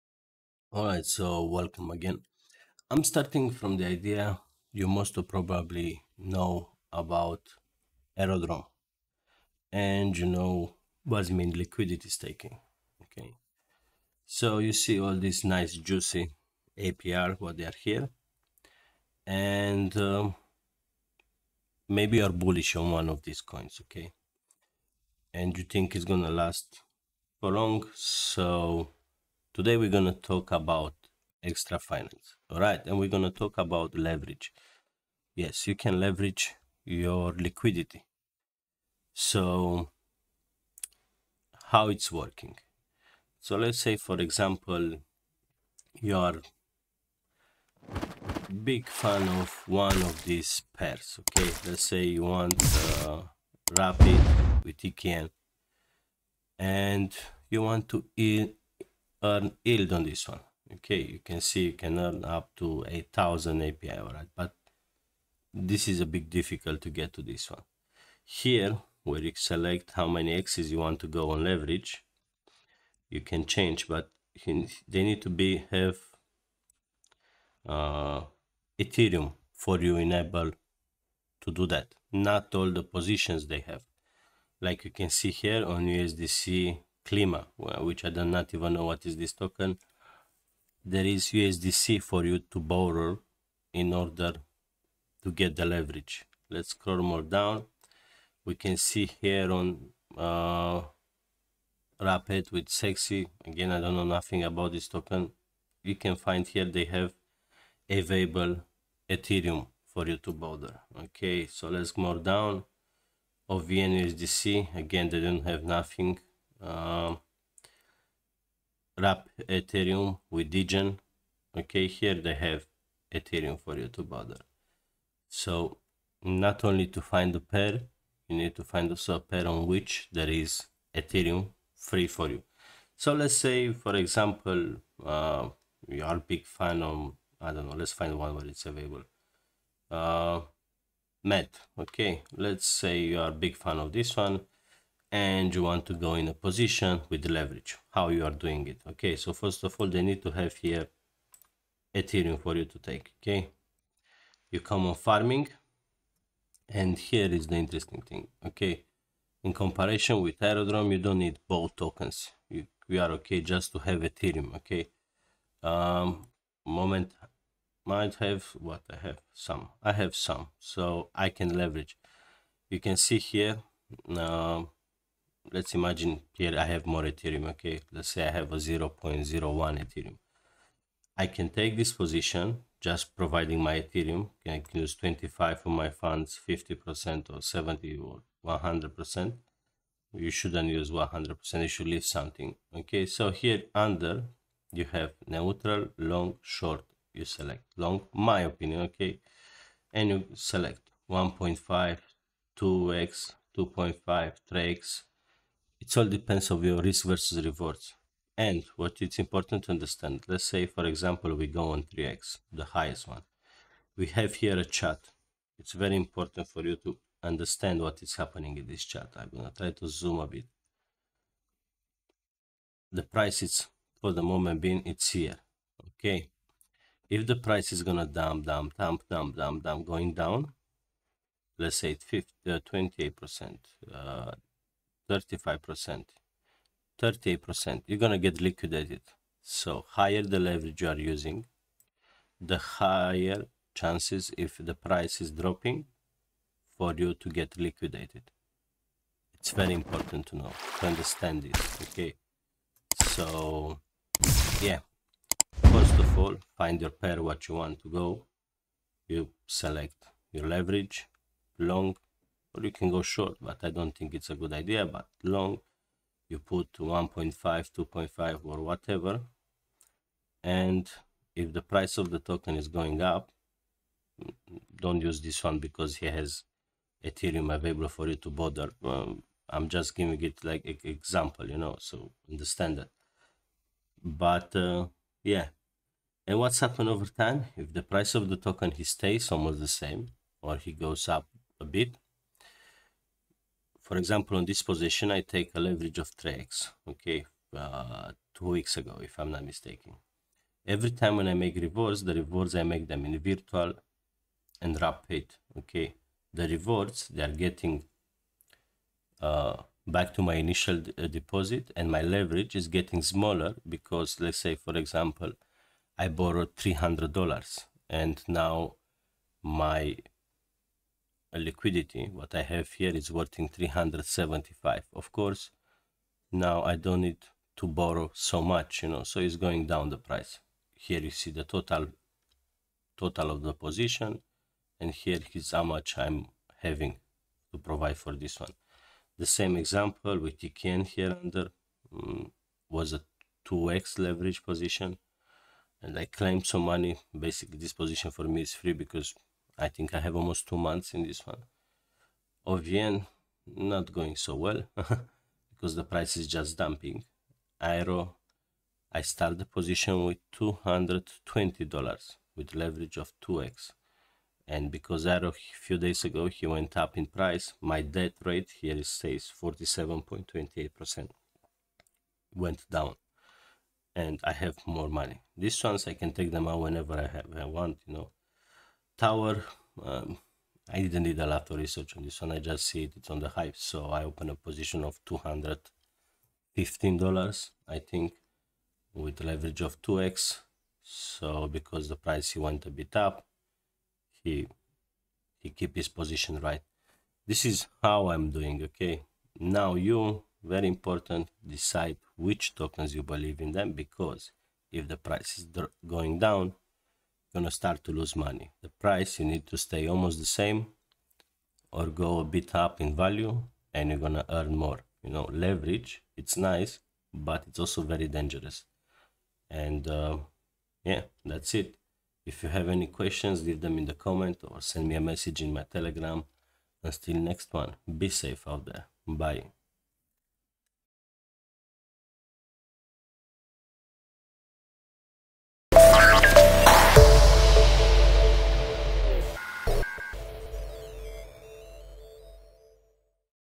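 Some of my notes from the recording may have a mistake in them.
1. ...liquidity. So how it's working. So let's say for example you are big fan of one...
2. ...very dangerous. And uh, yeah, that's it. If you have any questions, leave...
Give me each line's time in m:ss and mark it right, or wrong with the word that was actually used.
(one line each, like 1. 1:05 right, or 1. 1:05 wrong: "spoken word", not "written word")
1. 0:37 right
2. 6:57 right.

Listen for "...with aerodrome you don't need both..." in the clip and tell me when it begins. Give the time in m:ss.
2:40.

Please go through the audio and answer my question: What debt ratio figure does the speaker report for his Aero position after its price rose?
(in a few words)
47.28%.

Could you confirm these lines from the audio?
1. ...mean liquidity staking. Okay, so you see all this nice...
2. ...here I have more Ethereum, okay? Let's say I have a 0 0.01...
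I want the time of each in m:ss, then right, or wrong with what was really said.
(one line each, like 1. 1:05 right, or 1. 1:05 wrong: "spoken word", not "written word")
1. 0:11 right
2. 2:56 right.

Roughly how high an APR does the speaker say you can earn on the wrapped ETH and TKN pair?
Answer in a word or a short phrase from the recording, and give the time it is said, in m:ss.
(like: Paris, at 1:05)
8000, at 1:02.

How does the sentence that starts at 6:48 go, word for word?
The price you need to stay almost the same or go a bit up in value and you're gonna earn more.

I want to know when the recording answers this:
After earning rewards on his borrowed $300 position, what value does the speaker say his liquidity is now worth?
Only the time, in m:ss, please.
5:23.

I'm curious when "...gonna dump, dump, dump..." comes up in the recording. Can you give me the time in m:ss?
3:47.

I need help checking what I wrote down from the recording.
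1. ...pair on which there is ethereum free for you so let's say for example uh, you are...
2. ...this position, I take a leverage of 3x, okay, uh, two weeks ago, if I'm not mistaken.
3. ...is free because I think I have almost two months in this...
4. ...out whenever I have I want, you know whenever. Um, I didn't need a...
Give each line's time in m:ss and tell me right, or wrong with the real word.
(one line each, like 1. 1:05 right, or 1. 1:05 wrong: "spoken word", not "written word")
1. 2:09 right
2. 4:54 right
3. 5:48 right
4. 6:16 wrong: "tower", not "whenever".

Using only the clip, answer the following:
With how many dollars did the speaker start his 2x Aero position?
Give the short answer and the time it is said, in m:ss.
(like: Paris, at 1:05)
$220, at 6:00.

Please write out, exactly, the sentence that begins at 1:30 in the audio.
There is USDC for you to borrow in order to get the leverage.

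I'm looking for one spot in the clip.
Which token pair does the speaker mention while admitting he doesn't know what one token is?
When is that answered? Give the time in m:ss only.
1:25.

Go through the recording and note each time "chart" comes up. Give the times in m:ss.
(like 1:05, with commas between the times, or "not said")
3:34, 3:38.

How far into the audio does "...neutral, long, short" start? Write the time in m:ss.
3:15.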